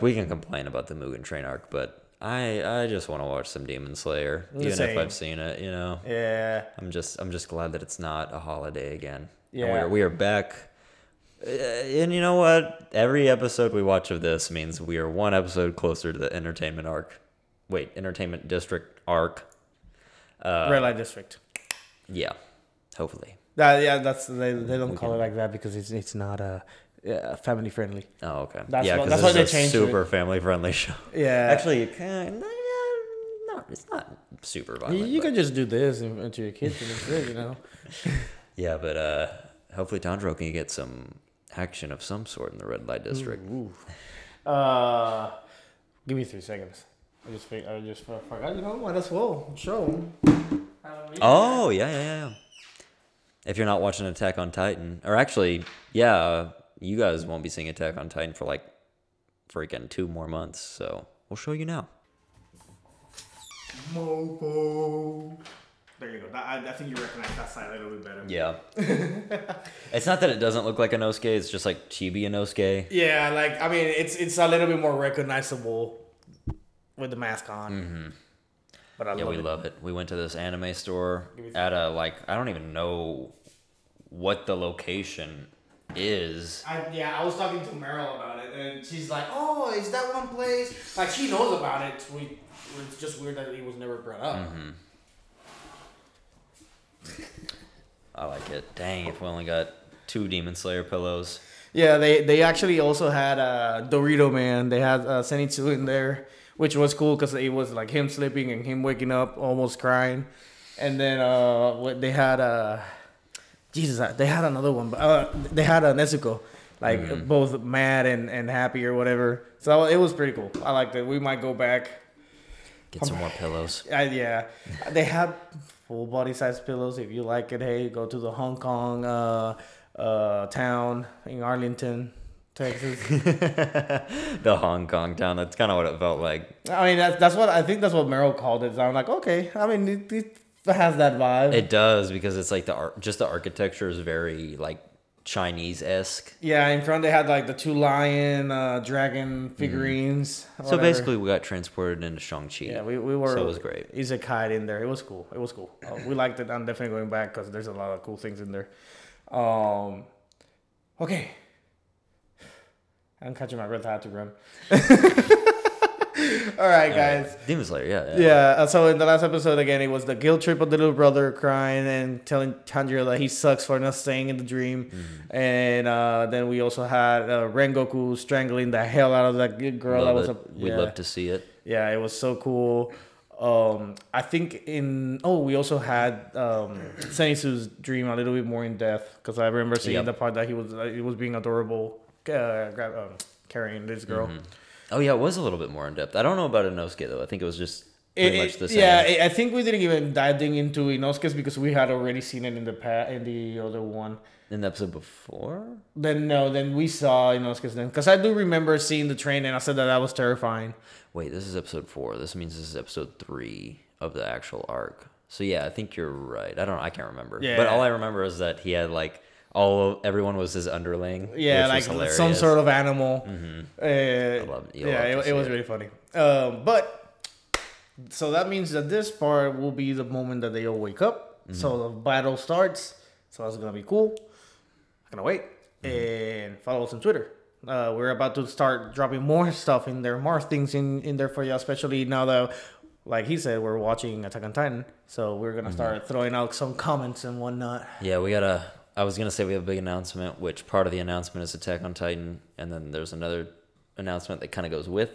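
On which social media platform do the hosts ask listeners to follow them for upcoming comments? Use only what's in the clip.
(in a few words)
Twitter.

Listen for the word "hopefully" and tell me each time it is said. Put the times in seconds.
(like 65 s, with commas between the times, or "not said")
22 s, 39 s.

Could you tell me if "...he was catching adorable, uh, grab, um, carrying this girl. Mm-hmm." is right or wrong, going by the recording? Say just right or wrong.
wrong.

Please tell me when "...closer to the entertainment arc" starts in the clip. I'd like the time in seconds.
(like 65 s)
15 s.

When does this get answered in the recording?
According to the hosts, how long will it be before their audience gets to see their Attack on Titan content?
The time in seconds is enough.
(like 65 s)
59 s.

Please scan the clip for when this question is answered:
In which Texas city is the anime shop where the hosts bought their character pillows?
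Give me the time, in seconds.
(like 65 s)
131 s.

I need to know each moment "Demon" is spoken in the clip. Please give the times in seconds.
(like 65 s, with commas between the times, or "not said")
3 s, 100 s, 167 s.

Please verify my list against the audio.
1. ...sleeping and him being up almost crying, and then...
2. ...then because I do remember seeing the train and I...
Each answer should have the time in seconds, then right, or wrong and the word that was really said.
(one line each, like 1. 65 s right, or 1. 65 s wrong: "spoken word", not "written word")
1. 108 s wrong: "waking", not "being"
2. 207 s right.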